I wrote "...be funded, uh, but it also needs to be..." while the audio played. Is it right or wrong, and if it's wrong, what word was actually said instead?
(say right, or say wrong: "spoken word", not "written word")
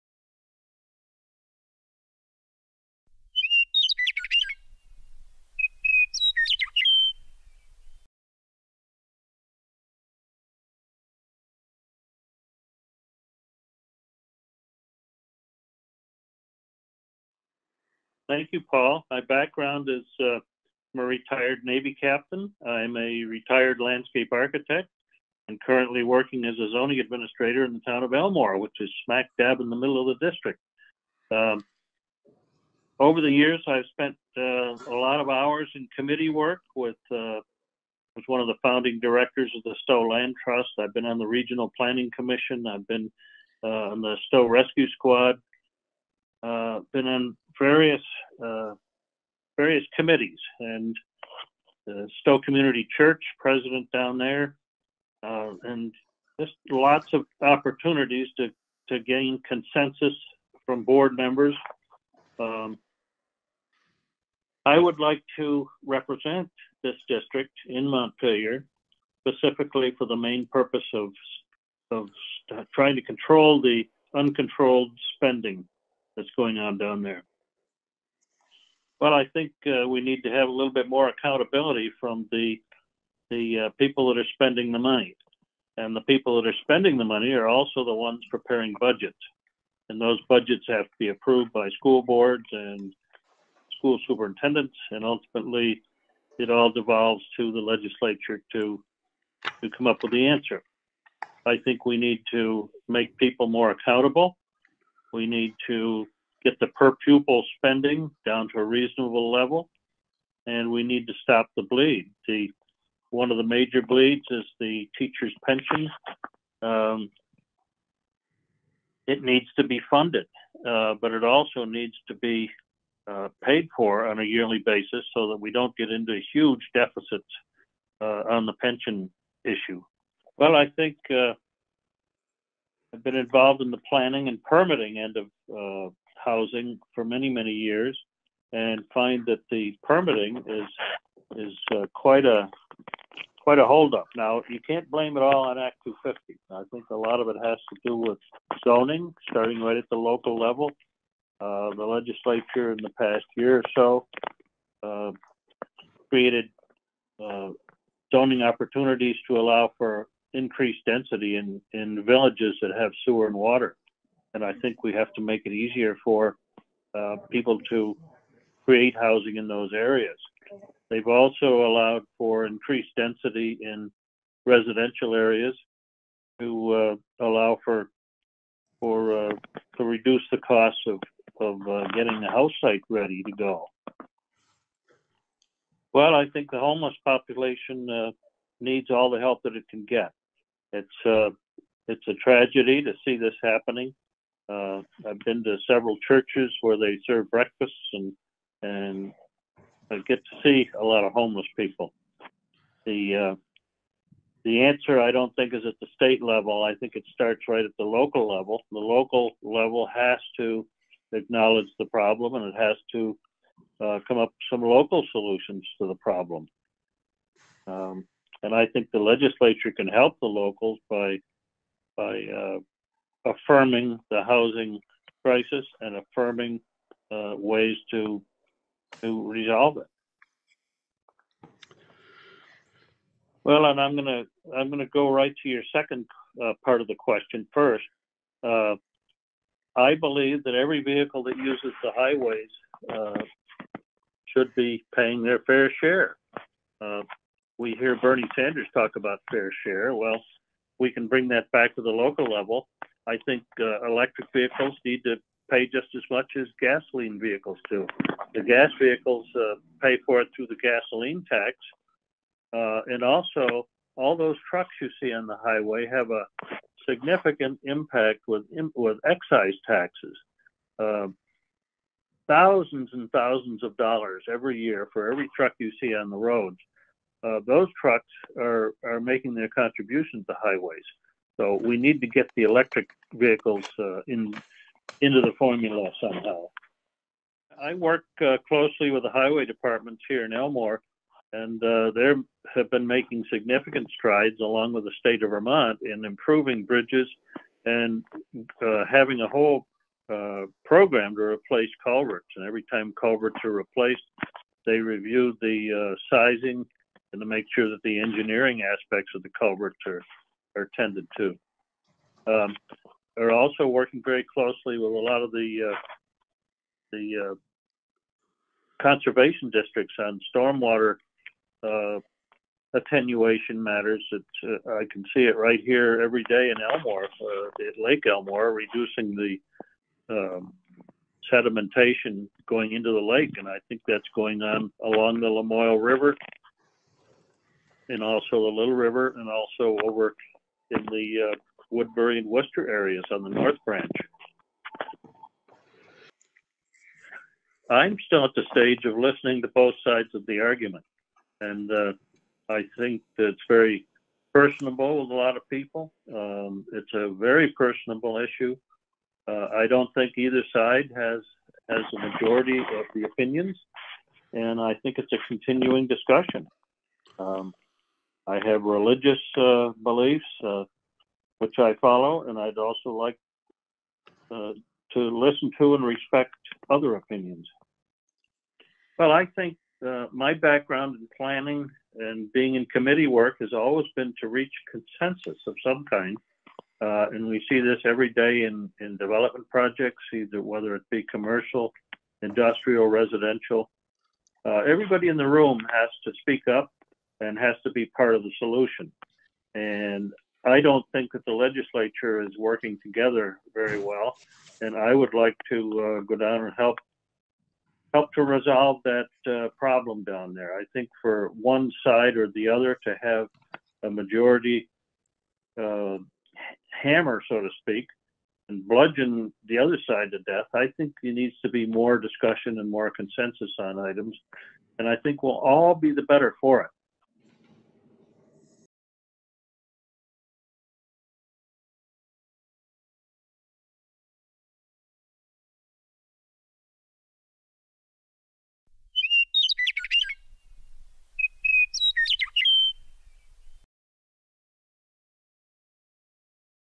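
right.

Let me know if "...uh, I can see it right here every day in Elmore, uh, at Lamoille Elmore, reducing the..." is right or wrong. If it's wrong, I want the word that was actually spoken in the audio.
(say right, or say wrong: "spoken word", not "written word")
wrong: "Lake", not "Lamoille".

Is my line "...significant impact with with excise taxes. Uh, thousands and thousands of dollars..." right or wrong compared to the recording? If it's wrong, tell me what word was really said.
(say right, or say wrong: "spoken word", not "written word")
right.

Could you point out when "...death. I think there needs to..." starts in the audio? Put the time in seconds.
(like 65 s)
420 s.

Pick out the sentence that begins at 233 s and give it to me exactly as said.
Well, and I'm gonna I'm gonna go right to your second uh, part of the question first.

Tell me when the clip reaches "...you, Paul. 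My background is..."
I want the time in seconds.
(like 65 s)
18 s.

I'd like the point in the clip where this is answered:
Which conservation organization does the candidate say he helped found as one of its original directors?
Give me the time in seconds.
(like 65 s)
39 s.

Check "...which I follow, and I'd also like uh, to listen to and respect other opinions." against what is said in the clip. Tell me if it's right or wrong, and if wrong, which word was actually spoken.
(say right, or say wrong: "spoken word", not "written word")
right.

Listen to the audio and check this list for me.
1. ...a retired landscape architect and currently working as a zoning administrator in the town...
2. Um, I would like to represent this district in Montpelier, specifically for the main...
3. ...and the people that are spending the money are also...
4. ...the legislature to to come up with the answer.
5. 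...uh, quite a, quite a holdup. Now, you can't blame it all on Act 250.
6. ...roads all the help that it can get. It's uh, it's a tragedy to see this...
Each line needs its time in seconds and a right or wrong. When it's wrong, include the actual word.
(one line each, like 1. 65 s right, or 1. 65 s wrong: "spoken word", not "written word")
1. 22 s right
2. 62 s right
3. 85 s right
4. 97 s right
5. 141 s right
6. 188 s wrong: "needs", not "roads".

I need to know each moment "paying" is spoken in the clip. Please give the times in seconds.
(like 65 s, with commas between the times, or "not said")
244 s.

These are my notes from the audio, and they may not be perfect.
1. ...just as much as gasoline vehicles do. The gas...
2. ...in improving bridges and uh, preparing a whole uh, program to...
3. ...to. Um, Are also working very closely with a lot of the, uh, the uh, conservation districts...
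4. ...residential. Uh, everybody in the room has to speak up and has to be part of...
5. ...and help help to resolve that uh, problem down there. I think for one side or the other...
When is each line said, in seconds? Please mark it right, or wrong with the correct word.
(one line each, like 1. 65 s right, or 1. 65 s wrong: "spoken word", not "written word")
1. 255 s right
2. 295 s wrong: "having", not "preparing"
3. 311 s right
4. 392 s right
5. 406 s right.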